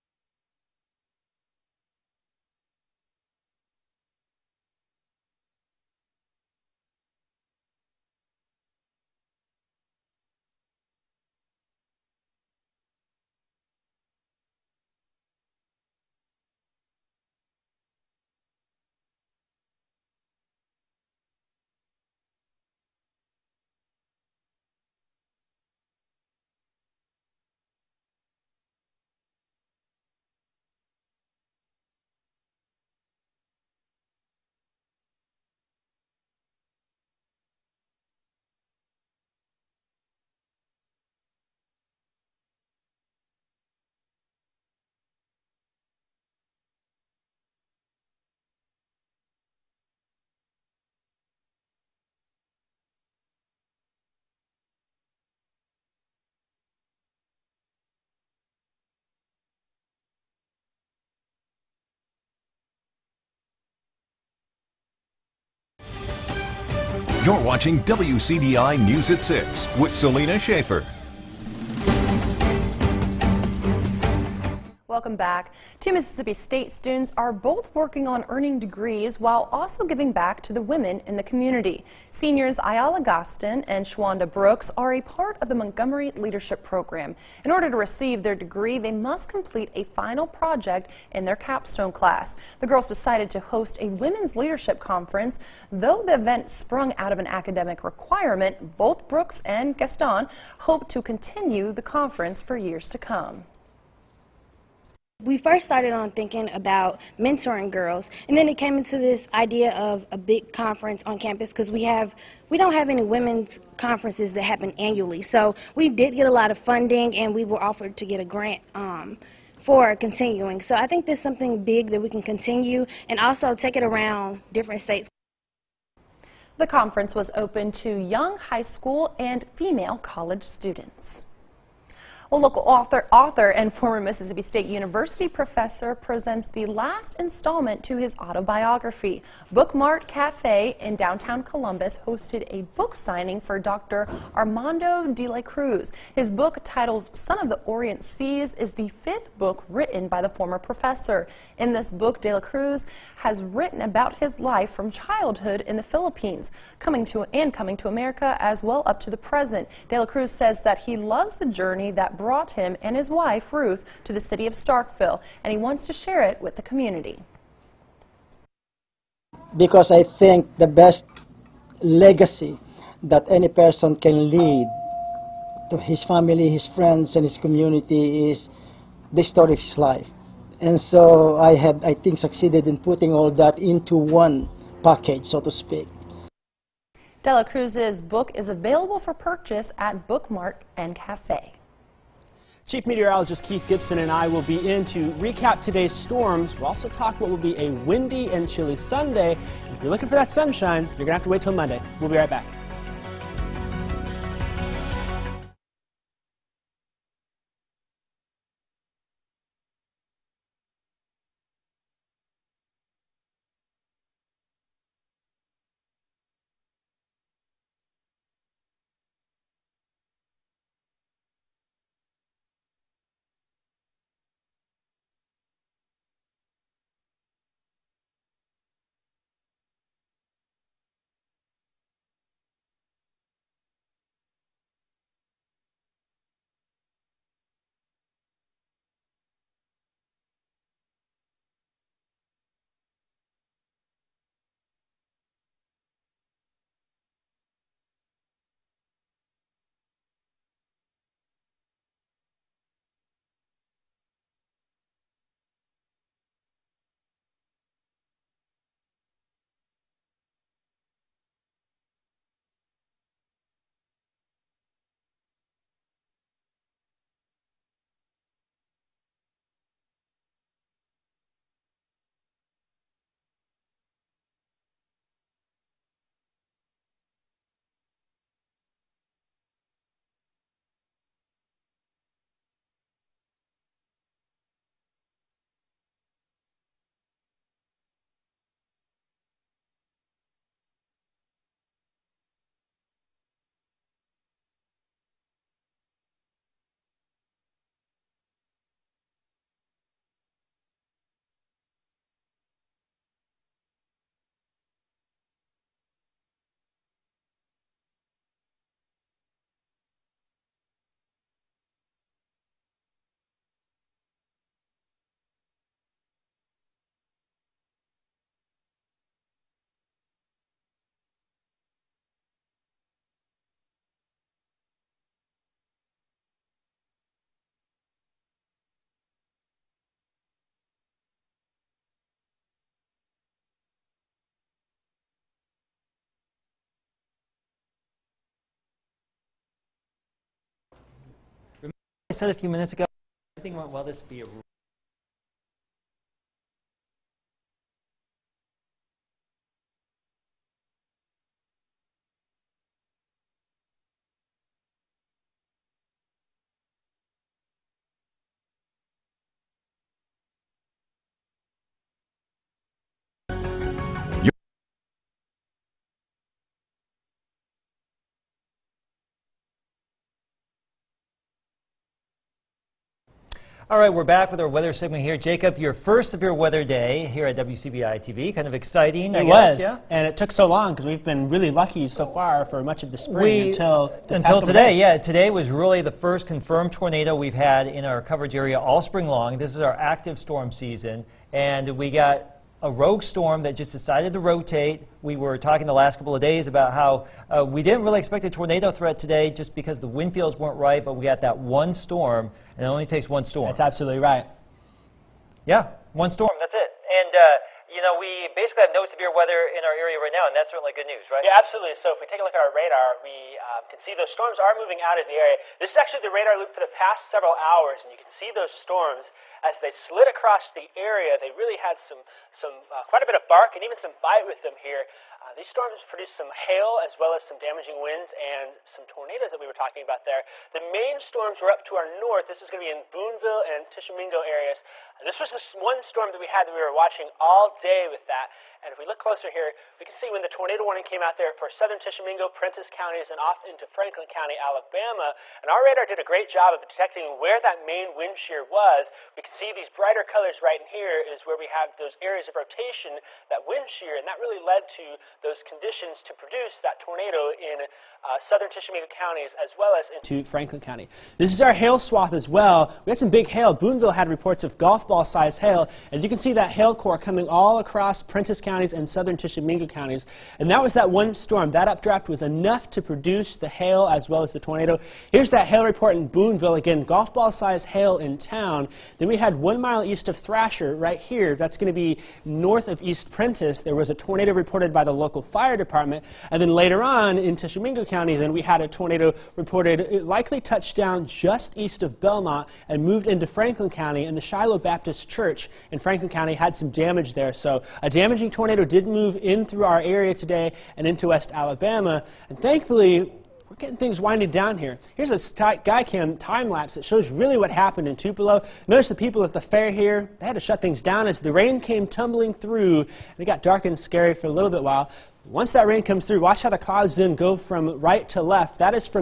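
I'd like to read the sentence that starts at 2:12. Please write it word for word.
Well, local author, author and former Mississippi State University professor presents the last installment to his autobiography.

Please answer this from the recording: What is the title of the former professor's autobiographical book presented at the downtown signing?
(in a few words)
Son of the Orient Seas.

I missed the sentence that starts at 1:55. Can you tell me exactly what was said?
So we did get a lot of funding, and we were offered to get a grant um, for continuing.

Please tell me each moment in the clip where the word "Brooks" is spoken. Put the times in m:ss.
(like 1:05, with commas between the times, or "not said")
1:24, 1:39.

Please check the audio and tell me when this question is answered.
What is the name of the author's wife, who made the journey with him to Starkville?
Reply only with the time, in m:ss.
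2:43.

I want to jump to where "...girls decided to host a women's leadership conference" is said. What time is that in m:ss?
1:32.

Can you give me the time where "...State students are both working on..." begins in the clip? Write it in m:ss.
1:16.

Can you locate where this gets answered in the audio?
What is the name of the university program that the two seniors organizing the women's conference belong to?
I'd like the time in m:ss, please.
1:25.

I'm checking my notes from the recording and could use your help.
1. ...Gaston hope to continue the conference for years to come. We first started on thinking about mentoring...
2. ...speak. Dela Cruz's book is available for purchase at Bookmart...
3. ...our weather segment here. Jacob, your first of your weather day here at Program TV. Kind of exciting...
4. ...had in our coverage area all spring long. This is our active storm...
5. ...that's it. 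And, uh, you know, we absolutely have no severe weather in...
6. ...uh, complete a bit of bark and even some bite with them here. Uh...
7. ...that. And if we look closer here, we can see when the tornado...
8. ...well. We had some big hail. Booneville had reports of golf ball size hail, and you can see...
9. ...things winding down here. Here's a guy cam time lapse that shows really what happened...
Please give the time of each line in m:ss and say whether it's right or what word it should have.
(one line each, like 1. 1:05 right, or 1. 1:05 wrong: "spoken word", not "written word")
1. 1:39 right
2. 3:05 right
3. 6:14 wrong: "WCBI", not "Program"
4. 6:27 right
5. 6:46 wrong: "basically", not "absolutely"
6. 7:02 wrong: "quite", not "complete"
7. 7:18 right
8. 7:42 right
9. 8:23 right.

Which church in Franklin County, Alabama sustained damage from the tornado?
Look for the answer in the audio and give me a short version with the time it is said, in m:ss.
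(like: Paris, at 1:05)
Shiloh Baptist Church, at 8:14.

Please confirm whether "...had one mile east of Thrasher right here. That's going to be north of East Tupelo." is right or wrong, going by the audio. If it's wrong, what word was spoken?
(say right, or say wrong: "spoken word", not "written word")
wrong: "Prentiss", not "Tupelo".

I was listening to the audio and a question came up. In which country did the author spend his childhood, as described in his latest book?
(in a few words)
Philippines.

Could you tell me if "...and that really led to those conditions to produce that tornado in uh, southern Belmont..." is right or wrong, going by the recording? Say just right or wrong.
wrong.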